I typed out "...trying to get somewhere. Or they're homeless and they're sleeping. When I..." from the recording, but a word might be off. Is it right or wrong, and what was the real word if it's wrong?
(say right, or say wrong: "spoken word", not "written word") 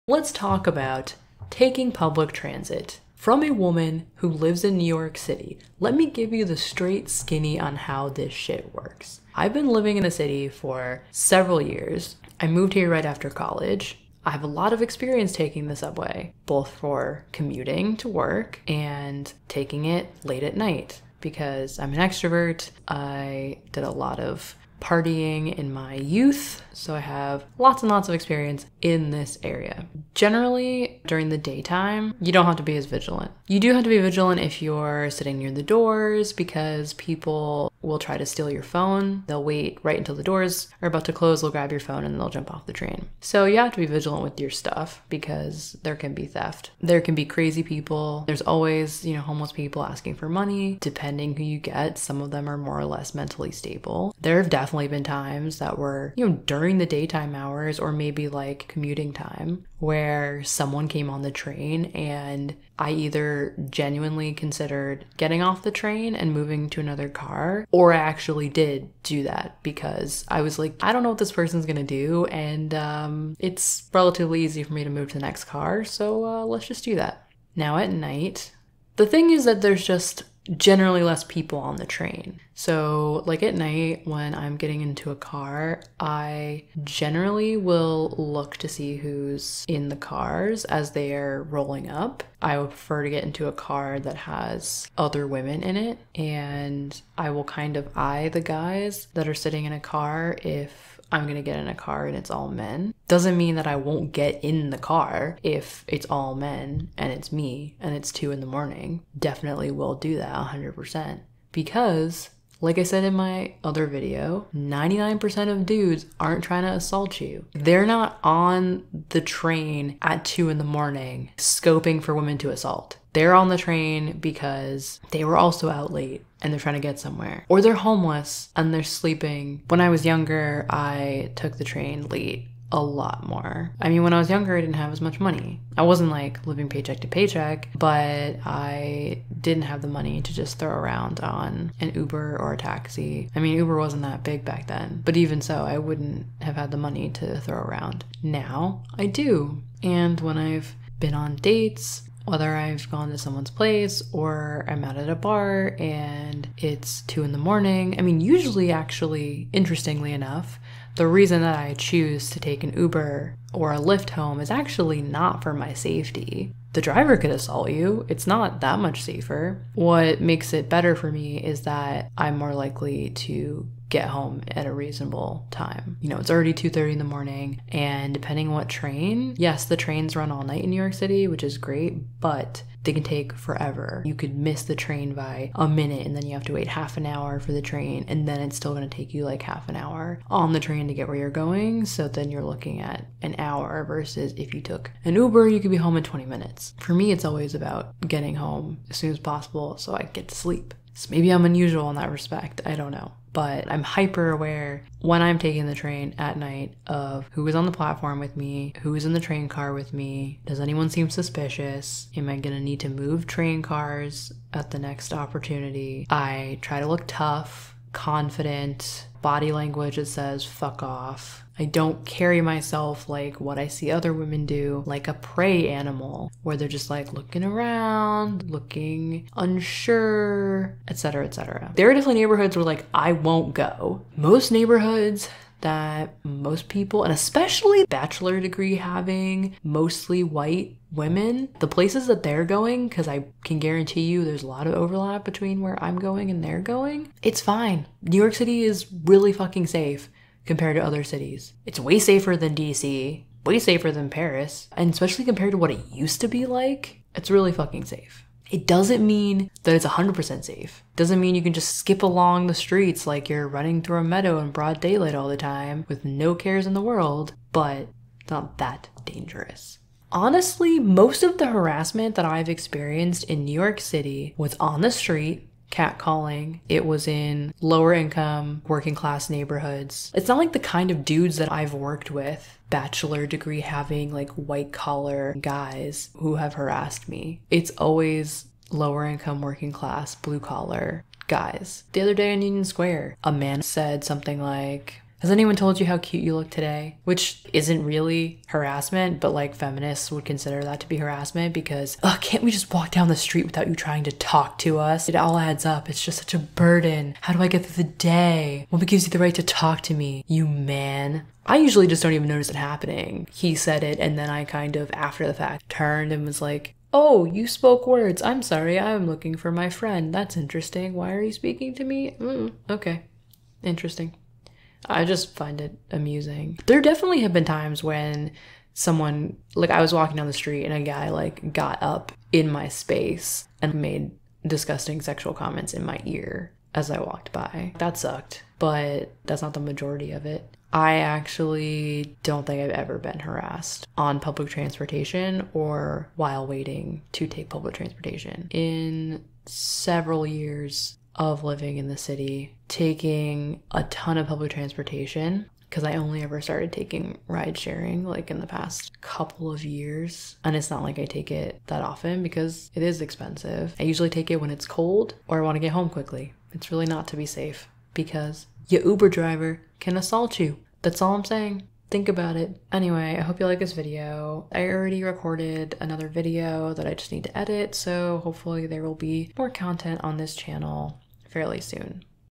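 right.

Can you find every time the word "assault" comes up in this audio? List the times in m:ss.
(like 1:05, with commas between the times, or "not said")
1:56, 2:02, 2:47, 6:09.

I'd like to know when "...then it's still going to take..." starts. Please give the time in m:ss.
3:08.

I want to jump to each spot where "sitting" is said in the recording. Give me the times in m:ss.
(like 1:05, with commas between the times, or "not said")
0:35, 1:39.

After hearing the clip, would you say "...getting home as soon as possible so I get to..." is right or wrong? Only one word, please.
right.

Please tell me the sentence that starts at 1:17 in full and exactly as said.
Now at night, the thing is that there's just generally less people on the train.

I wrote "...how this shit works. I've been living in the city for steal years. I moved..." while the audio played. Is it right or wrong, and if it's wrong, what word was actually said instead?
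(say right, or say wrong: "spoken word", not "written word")
wrong: "several", not "steal".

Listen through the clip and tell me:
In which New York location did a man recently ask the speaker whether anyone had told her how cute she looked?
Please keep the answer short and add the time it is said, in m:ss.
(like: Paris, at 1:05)
Union Square, at 4:52.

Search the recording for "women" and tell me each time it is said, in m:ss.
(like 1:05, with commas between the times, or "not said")
1:35, 2:02, 3:44, 4:00.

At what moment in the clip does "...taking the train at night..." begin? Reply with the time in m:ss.
3:25.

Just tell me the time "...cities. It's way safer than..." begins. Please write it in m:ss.
4:11.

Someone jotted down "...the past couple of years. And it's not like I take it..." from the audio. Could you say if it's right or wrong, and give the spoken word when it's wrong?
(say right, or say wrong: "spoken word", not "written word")
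right.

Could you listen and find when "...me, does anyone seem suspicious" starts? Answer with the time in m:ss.
3:29.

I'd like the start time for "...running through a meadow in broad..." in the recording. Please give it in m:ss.
4:23.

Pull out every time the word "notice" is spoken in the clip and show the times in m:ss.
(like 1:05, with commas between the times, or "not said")
5:12.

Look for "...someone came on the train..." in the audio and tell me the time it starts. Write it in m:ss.
1:00.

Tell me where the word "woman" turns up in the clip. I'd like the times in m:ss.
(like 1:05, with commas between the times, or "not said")
0:03.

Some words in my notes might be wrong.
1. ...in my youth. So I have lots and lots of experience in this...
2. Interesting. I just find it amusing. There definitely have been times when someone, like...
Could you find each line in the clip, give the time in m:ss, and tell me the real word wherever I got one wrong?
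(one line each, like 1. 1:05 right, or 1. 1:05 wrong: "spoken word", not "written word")
1. 0:25 right
2. 5:23 right.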